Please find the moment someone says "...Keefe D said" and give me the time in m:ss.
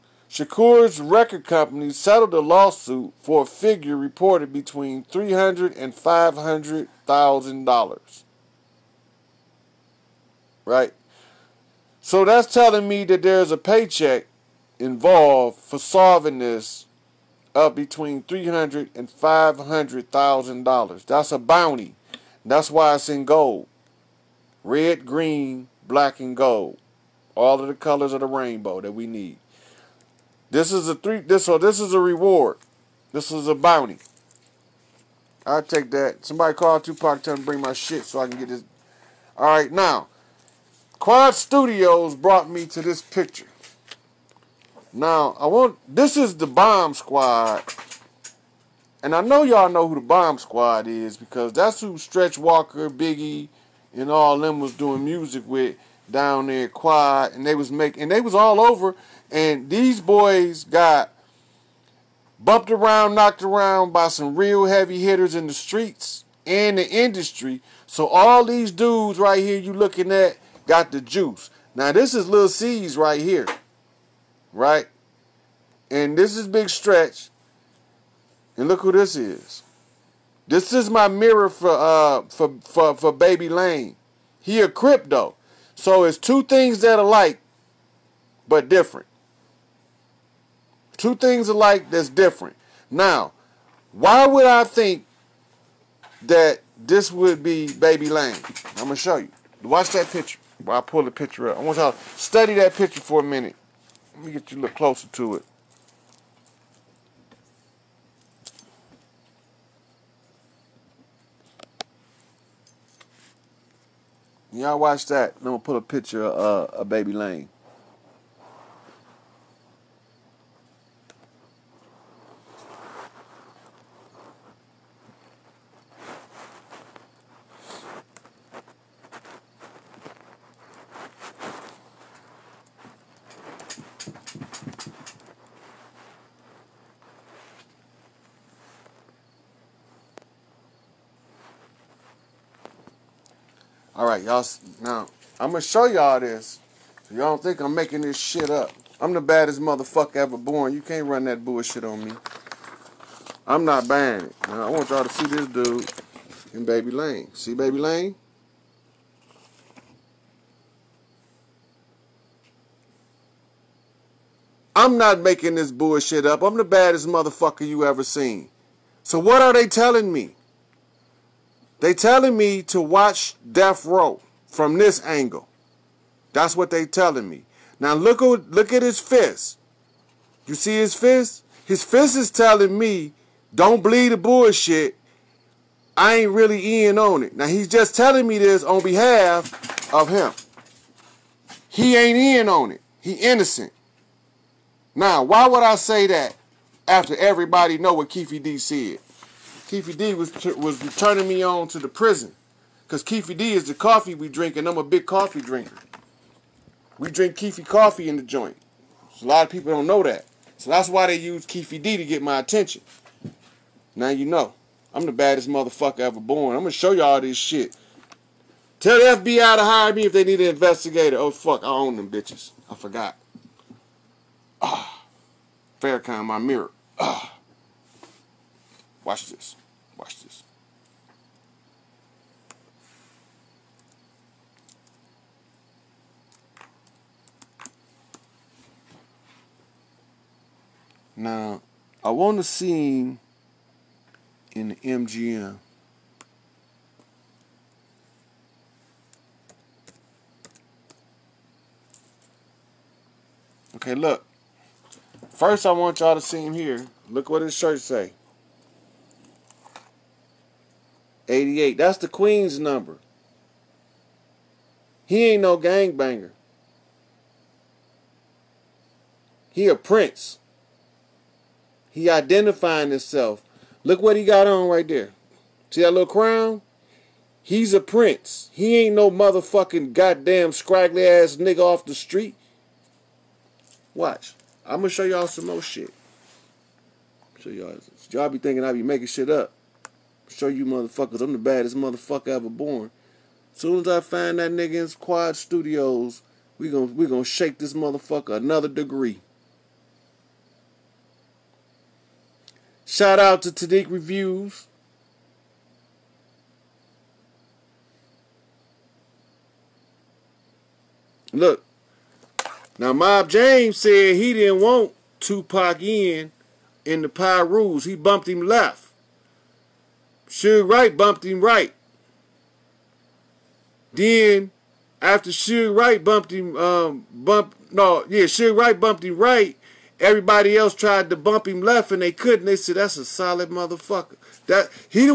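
3:18.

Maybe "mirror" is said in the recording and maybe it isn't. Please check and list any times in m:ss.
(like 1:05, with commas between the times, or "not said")
1:21, 3:46.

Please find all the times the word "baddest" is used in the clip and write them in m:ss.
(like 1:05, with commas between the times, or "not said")
2:29, 2:46, 3:35, 4:51.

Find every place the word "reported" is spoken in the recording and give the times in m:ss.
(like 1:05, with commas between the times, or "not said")
0:03.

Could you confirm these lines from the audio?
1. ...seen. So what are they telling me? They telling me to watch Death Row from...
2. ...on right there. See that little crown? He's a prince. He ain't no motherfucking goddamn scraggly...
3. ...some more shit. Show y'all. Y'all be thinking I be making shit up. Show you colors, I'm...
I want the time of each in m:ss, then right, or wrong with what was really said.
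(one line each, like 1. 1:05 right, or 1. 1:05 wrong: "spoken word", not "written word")
1. 2:48 right
2. 4:34 right
3. 4:45 wrong: "motherfuckers", not "colors".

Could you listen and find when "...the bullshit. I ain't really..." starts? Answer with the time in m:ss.
3:04.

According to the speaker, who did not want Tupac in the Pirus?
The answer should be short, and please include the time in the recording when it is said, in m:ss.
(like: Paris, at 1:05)
Mob James, at 5:12.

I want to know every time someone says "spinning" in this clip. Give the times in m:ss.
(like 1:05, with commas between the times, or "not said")
not said.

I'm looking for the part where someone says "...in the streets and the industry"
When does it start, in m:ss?
1:05.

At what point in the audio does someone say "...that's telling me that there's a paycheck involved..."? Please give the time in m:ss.
0:12.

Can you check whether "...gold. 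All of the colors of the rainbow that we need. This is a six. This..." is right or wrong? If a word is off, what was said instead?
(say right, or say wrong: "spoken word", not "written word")
wrong: "three", not "six".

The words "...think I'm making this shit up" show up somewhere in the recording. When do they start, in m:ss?
2:27.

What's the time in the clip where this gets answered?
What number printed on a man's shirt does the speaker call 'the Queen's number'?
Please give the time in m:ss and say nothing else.
4:21.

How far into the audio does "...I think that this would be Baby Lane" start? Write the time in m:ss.
1:34.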